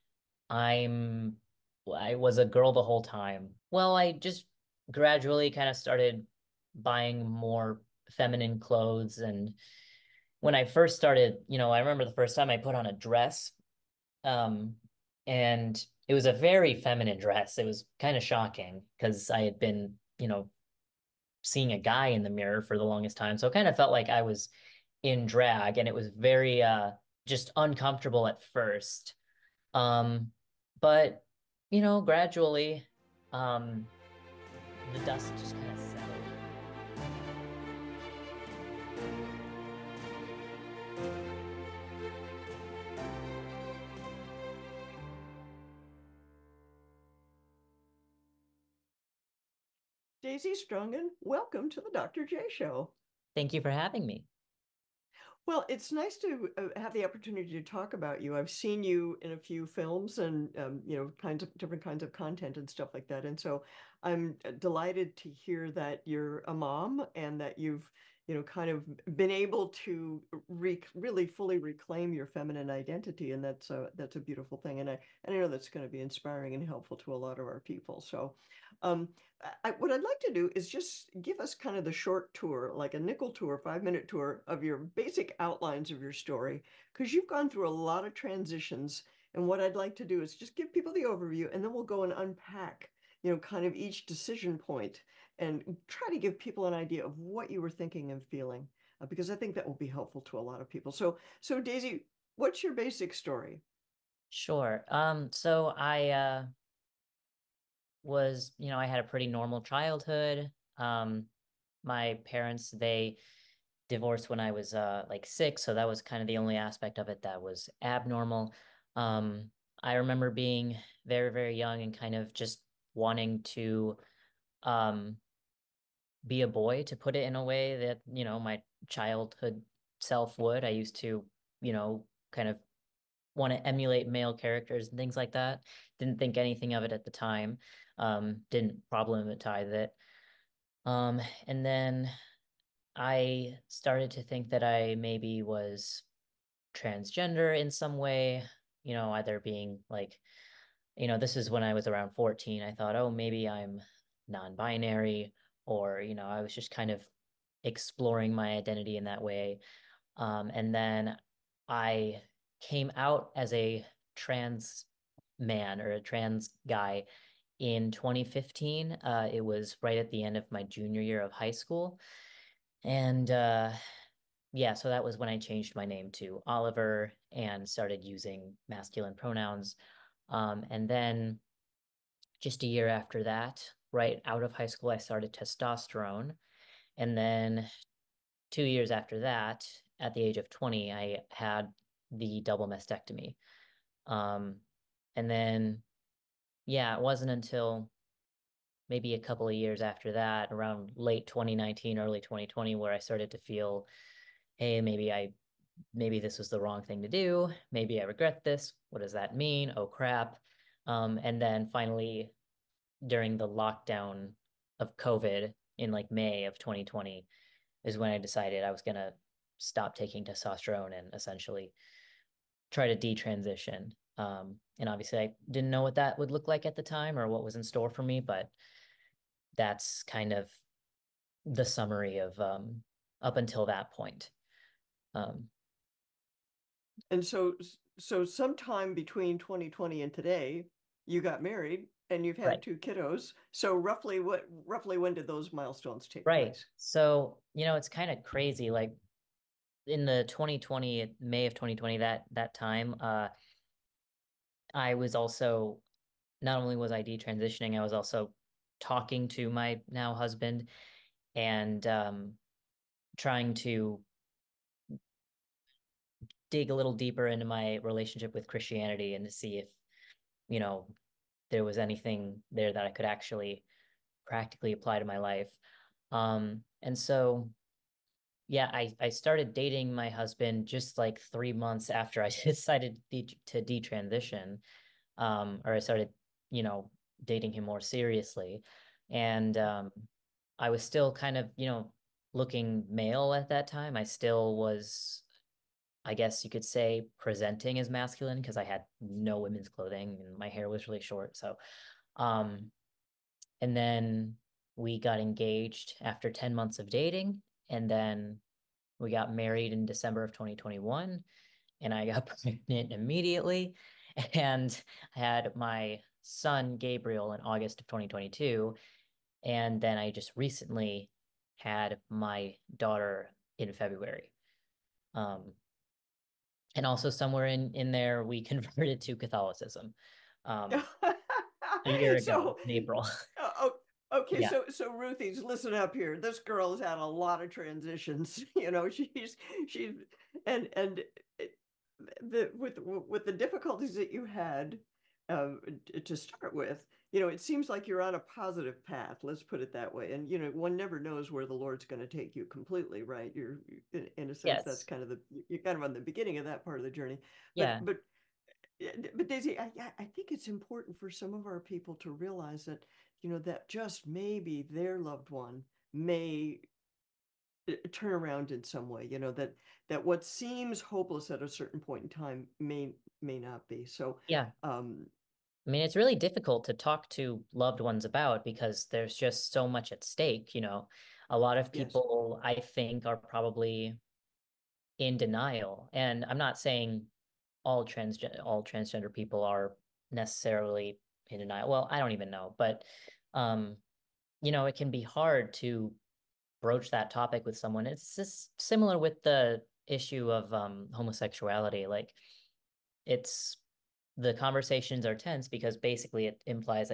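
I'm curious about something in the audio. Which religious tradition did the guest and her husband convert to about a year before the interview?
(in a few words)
Catholicism.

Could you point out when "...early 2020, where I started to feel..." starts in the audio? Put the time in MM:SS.
03:21.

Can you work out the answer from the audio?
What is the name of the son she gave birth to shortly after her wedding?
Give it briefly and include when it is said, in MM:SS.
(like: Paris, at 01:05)
Gabriel, at 05:16.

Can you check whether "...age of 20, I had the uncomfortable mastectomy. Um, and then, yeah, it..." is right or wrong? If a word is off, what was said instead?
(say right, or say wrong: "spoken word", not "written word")
wrong: "double", not "uncomfortable".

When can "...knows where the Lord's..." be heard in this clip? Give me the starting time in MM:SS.
05:50.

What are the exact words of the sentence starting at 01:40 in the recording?
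So, so Daisy, what's your basic story?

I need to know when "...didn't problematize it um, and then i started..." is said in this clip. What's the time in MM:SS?
02:18.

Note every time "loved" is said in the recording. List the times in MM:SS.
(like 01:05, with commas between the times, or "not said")
06:04, 06:17.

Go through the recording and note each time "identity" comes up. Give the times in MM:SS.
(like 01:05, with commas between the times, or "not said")
01:12, 02:38.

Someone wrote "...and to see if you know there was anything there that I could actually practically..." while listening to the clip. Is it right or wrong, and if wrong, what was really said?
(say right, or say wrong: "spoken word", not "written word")
right.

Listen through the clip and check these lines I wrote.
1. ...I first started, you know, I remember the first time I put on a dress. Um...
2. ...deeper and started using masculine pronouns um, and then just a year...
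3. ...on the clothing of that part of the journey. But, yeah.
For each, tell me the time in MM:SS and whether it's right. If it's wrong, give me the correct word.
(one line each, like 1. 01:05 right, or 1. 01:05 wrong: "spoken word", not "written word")
1. 00:10 right
2. 02:56 wrong: "oliver", not "deeper"
3. 05:55 wrong: "beginning", not "clothing".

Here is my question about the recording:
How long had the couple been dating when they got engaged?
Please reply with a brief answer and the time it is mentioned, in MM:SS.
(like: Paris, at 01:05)
10 months, at 05:06.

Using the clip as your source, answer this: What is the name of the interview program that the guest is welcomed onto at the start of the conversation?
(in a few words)
The Dr. J Show.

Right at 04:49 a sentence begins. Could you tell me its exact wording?
And um, I was still kind of, you know, looking male at that time.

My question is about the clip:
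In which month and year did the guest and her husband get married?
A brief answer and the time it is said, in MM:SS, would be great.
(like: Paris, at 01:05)
December 2021, at 05:09.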